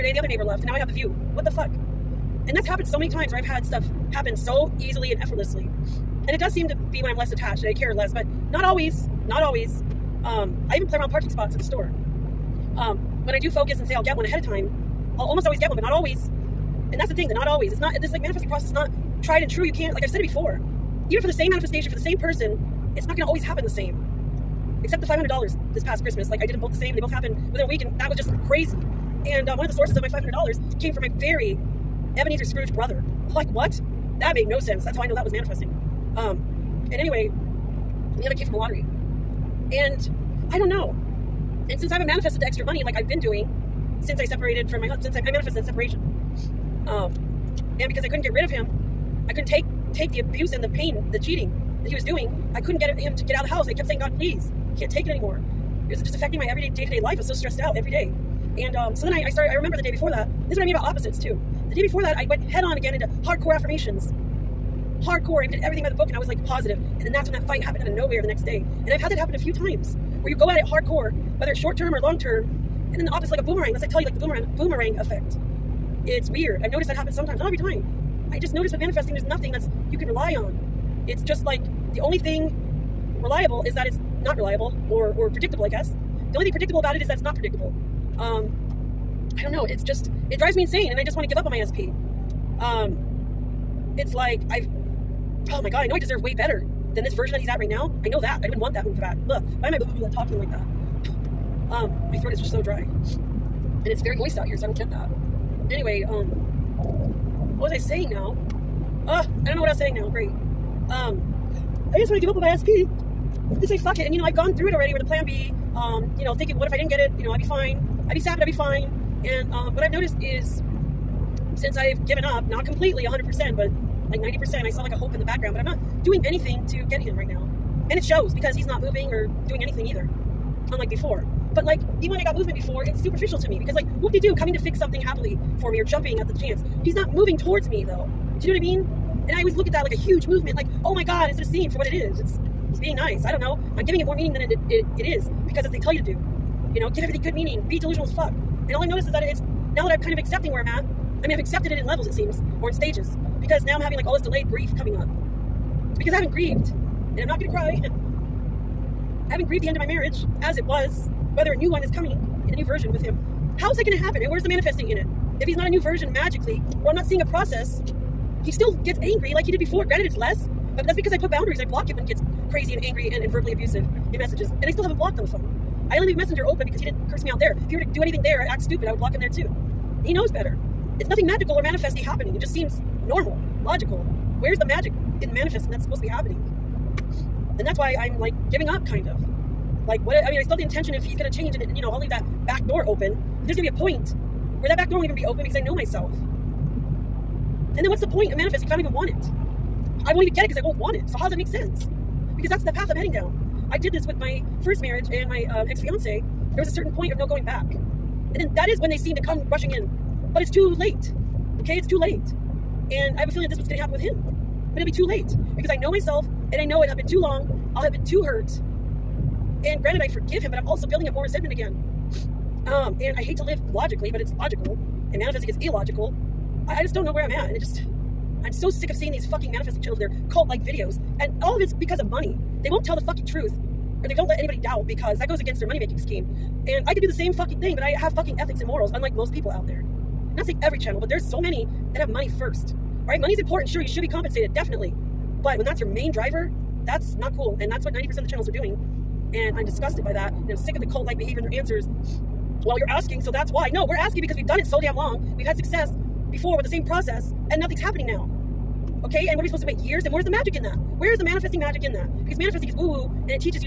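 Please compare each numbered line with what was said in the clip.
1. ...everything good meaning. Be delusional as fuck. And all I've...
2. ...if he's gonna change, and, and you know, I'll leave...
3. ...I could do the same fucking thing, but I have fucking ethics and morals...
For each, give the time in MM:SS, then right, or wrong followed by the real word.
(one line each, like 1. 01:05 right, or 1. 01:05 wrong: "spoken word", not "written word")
1. 02:27 right
2. 03:10 right
3. 03:56 right.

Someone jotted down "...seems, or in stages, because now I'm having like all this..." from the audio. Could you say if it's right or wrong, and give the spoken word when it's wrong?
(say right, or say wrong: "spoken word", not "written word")
right.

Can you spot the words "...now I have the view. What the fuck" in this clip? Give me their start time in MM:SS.
00:00.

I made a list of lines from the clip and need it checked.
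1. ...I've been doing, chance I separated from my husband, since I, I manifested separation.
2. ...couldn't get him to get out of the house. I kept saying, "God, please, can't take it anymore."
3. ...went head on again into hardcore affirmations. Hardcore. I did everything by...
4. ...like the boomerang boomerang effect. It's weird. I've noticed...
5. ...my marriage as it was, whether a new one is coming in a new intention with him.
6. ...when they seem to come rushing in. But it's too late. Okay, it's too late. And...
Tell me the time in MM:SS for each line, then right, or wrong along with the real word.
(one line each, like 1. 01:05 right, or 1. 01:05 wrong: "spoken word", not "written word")
1. 00:42 wrong: "since", not "chance"
2. 00:52 right
3. 01:02 right
4. 01:14 right
5. 02:39 wrong: "version", not "intention"
6. 03:28 right.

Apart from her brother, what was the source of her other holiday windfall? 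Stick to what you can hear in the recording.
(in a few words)
a lottery.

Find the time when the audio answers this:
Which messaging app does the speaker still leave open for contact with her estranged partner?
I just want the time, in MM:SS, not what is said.
02:56.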